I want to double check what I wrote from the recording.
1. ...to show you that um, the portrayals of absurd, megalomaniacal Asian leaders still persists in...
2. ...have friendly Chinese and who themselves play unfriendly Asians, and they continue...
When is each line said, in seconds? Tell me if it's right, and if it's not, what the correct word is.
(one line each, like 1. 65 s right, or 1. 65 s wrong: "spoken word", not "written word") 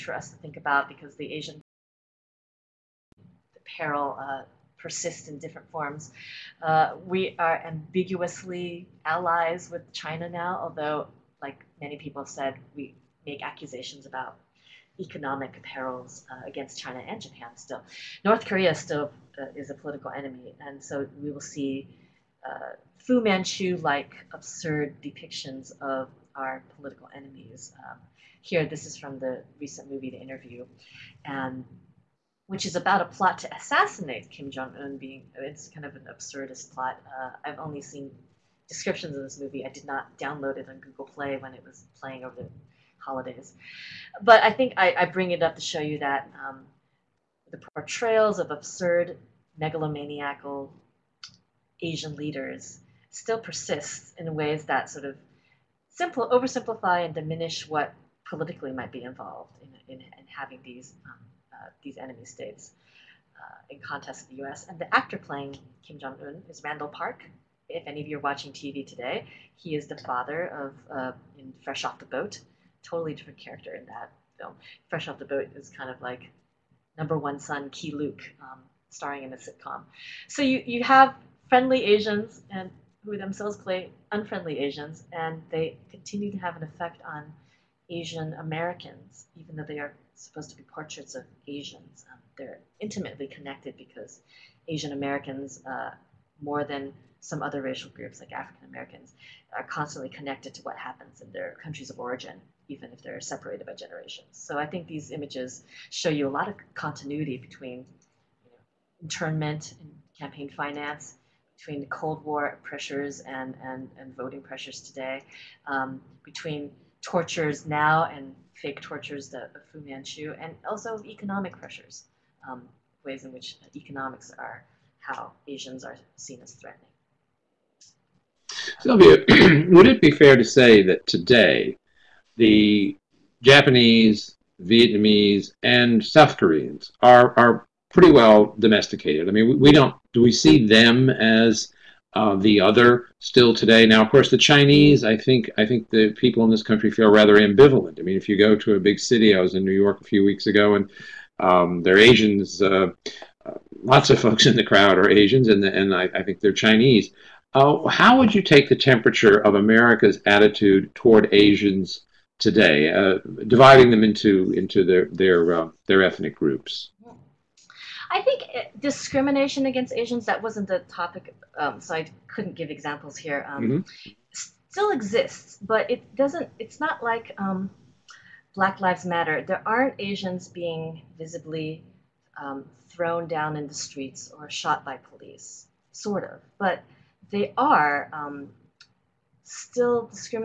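1. 45 s right
2. 80 s wrong: "Asians", not "Chinese".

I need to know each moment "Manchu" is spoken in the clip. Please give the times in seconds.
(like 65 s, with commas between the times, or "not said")
23 s, 119 s.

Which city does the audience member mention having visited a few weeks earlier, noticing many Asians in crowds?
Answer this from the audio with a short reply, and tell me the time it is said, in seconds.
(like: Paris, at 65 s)
New York, at 149 s.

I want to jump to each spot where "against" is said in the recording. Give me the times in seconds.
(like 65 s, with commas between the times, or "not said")
16 s, 169 s.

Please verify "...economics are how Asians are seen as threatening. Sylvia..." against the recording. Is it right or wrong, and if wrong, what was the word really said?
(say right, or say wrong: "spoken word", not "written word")
right.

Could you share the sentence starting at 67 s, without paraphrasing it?
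If any of you are watching TV today, he is the father of uh, in Fresh Off the Boat.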